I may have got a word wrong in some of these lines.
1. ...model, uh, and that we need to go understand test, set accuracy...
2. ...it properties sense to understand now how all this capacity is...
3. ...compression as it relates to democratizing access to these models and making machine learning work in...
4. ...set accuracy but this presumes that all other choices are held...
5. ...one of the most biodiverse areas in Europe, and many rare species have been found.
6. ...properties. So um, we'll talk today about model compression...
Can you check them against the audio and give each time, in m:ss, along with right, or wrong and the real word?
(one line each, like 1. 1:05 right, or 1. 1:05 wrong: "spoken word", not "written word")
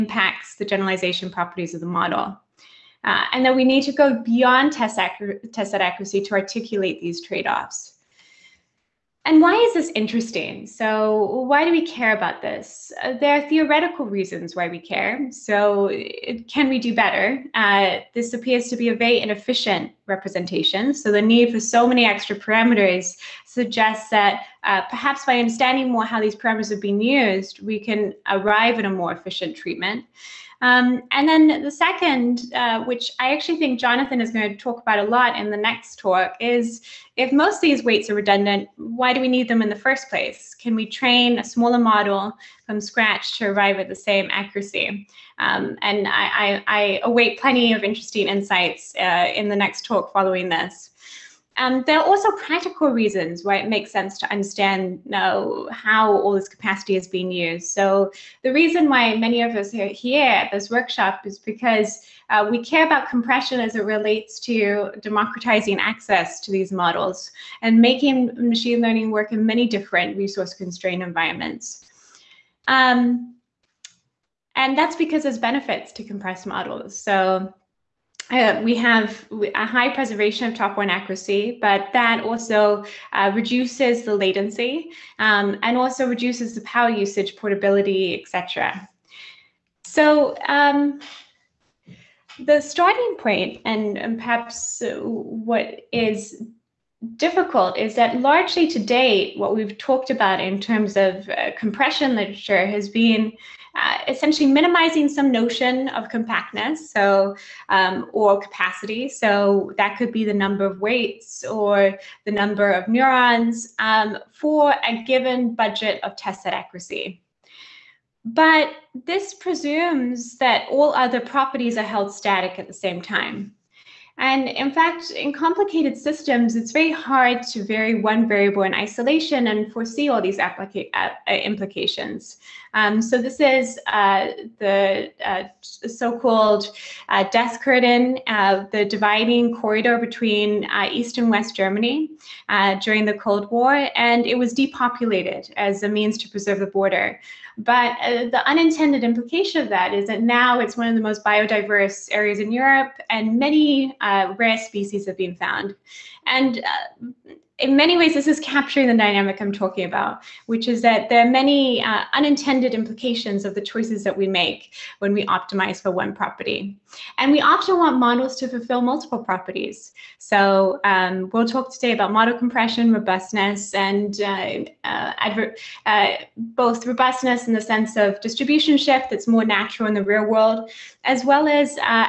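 1. 0:01 wrong: "beyond", not "understand"
2. 0:53 wrong: "makes", not "properties"
3. 1:03 right
4. 1:56 wrong: "properties", not "choices"
5. 2:30 right
6. 2:49 right.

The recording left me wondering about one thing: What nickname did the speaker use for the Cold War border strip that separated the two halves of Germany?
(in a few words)
death curtain.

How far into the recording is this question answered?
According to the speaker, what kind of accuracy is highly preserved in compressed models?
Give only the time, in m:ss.
1:20.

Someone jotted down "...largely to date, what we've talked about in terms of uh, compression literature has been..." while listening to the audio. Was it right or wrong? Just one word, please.
right.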